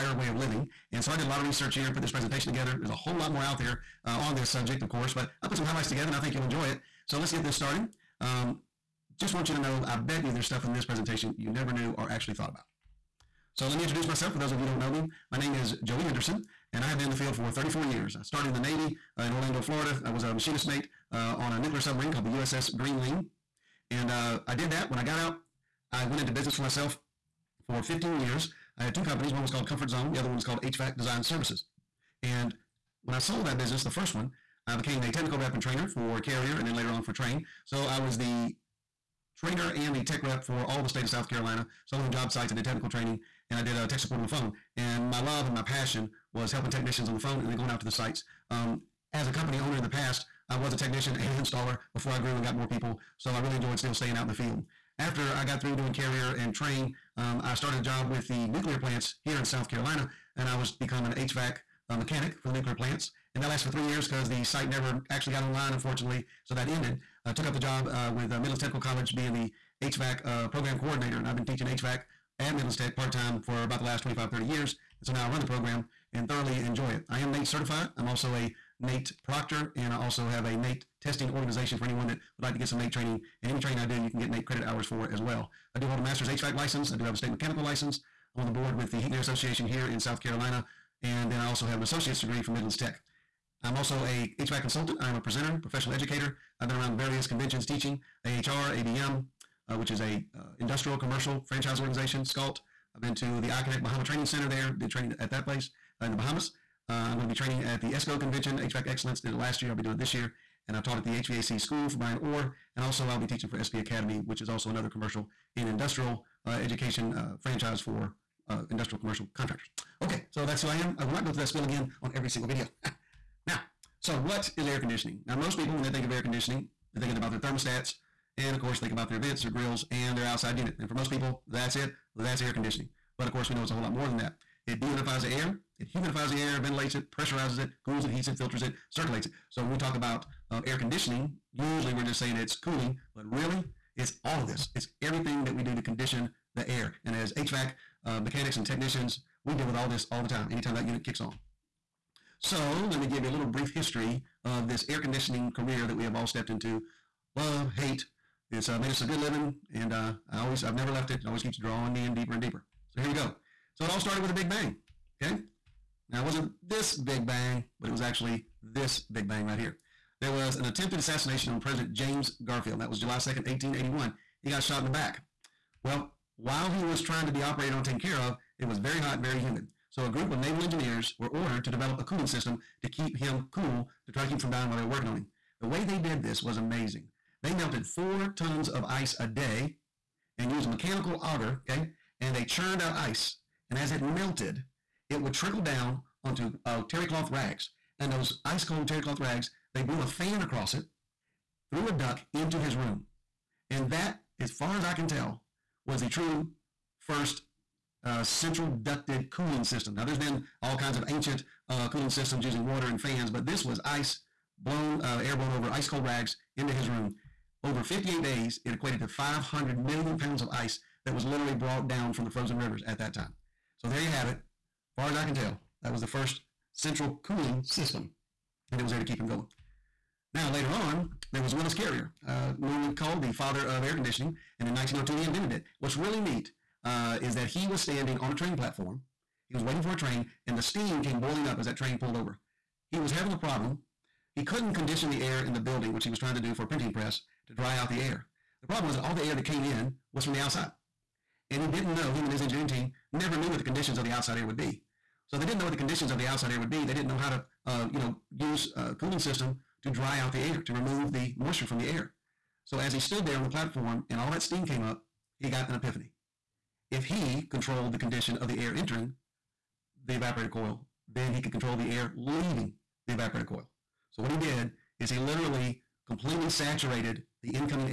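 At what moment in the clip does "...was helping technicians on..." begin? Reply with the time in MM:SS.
00:46.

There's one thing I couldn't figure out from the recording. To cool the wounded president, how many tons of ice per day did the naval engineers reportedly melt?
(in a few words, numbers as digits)
4 tons.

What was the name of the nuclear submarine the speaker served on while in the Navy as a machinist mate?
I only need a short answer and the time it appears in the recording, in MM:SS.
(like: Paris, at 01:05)
USS Greenling, at 00:22.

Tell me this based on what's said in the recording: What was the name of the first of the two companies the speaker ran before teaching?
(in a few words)
Comfort Zone.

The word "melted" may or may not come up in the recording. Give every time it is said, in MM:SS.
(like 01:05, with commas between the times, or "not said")
03:07, 03:14.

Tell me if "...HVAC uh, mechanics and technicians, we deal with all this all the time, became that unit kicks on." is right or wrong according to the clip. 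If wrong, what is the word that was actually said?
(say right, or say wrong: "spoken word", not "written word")
wrong: "anytime", not "became".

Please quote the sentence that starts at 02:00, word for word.
Okay, so that's who I am.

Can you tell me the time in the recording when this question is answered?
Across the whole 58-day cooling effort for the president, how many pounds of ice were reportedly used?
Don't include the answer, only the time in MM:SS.
03:39.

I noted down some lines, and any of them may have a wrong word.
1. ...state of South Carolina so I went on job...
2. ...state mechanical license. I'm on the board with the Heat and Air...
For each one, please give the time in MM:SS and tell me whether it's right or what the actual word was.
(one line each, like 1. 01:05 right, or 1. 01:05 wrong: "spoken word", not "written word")
1. 00:40 right
2. 01:27 right.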